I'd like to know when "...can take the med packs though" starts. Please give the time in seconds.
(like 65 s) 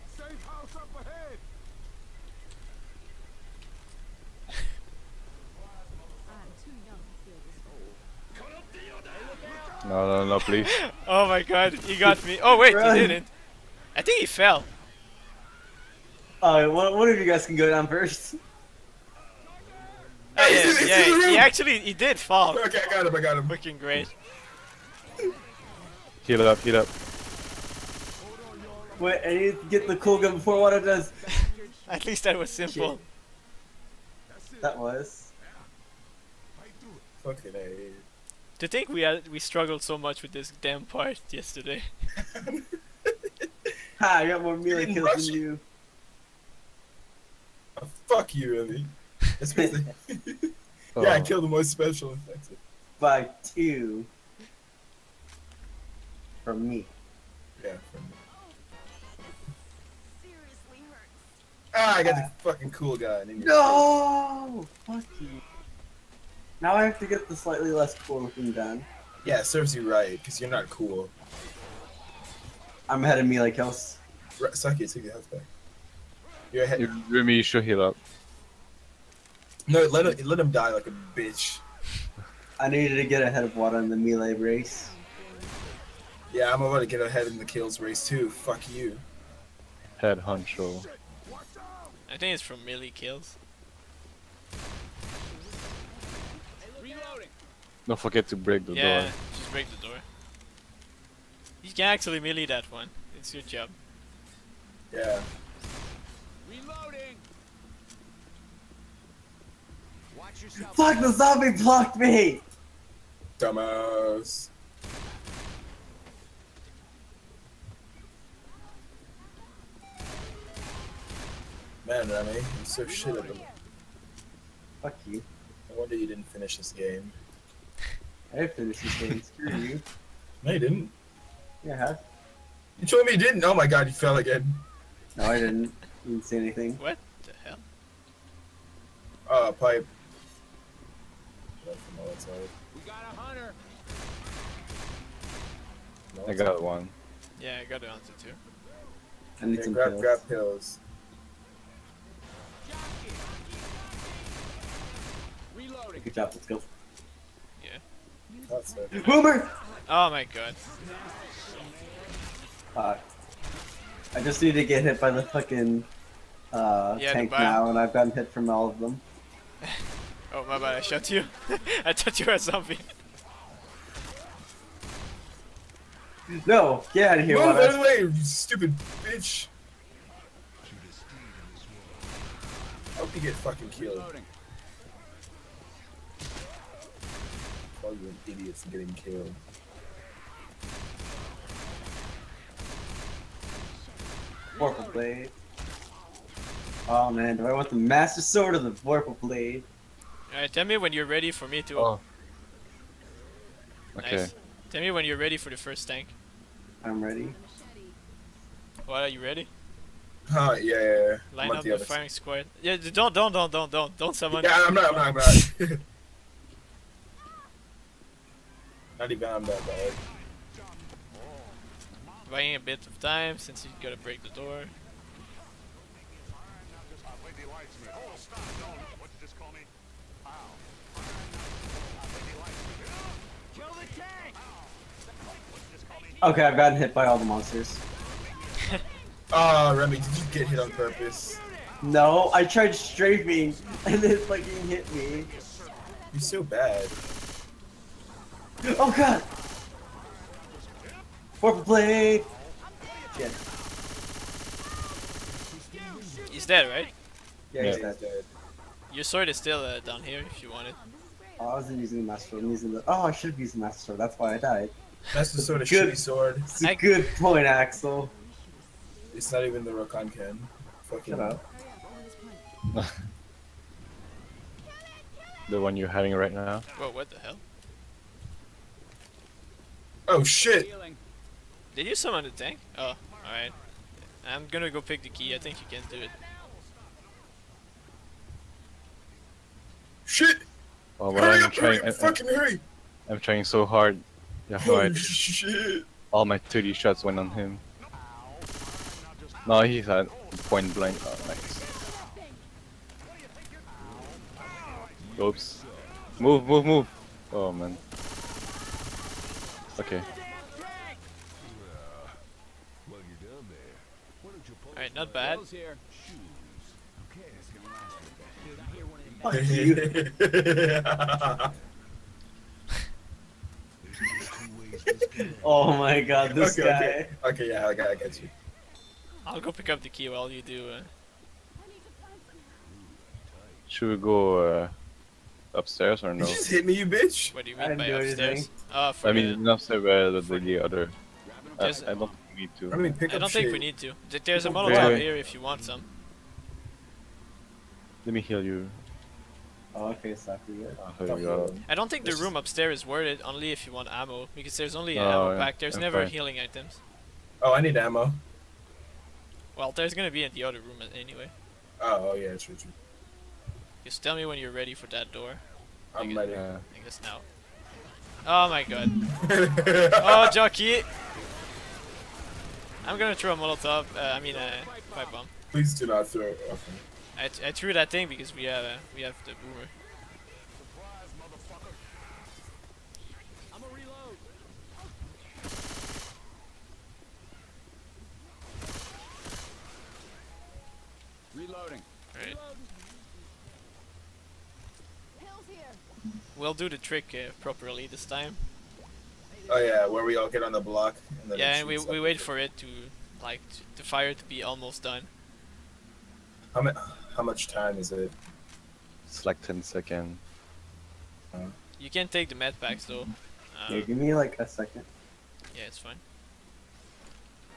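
411 s.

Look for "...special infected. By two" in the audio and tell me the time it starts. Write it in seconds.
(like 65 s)
51 s.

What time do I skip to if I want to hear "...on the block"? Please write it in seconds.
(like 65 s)
400 s.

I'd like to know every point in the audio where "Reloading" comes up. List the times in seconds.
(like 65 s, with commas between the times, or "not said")
155 s, 391 s.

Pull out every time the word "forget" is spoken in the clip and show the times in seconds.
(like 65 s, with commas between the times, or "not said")
97 s.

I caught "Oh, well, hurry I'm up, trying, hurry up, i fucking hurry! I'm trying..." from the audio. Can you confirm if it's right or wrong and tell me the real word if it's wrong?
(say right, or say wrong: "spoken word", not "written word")
right.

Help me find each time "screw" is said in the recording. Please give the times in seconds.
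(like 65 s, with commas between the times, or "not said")
129 s.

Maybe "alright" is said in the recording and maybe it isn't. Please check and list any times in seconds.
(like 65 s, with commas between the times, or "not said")
16 s, 200 s, 283 s, 314 s.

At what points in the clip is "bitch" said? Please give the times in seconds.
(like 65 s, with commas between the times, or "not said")
81 s, 179 s, 336 s.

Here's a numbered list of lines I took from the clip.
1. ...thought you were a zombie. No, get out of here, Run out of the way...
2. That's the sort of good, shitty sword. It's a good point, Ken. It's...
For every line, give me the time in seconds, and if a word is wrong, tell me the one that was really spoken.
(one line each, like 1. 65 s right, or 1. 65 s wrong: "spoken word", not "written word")
1. 171 s wrong: "Move", not "Run"
2. 265 s wrong: "Axel", not "Ken".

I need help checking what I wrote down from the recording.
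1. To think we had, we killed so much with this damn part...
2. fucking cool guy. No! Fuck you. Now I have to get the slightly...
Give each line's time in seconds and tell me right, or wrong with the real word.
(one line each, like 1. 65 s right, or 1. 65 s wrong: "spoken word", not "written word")
1. 38 s wrong: "struggled", not "killed"
2. 62 s right.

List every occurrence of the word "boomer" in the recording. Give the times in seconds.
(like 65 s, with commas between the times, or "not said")
159 s, 379 s.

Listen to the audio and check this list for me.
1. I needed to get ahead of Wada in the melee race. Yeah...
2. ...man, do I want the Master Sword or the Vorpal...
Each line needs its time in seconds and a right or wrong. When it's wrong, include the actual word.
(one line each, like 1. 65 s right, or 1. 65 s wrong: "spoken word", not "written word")
1. 82 s right
2. 197 s right.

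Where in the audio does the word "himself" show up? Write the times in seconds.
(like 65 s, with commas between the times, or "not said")
not said.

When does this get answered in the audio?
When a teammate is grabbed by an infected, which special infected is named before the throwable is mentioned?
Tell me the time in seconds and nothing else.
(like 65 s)
370 s.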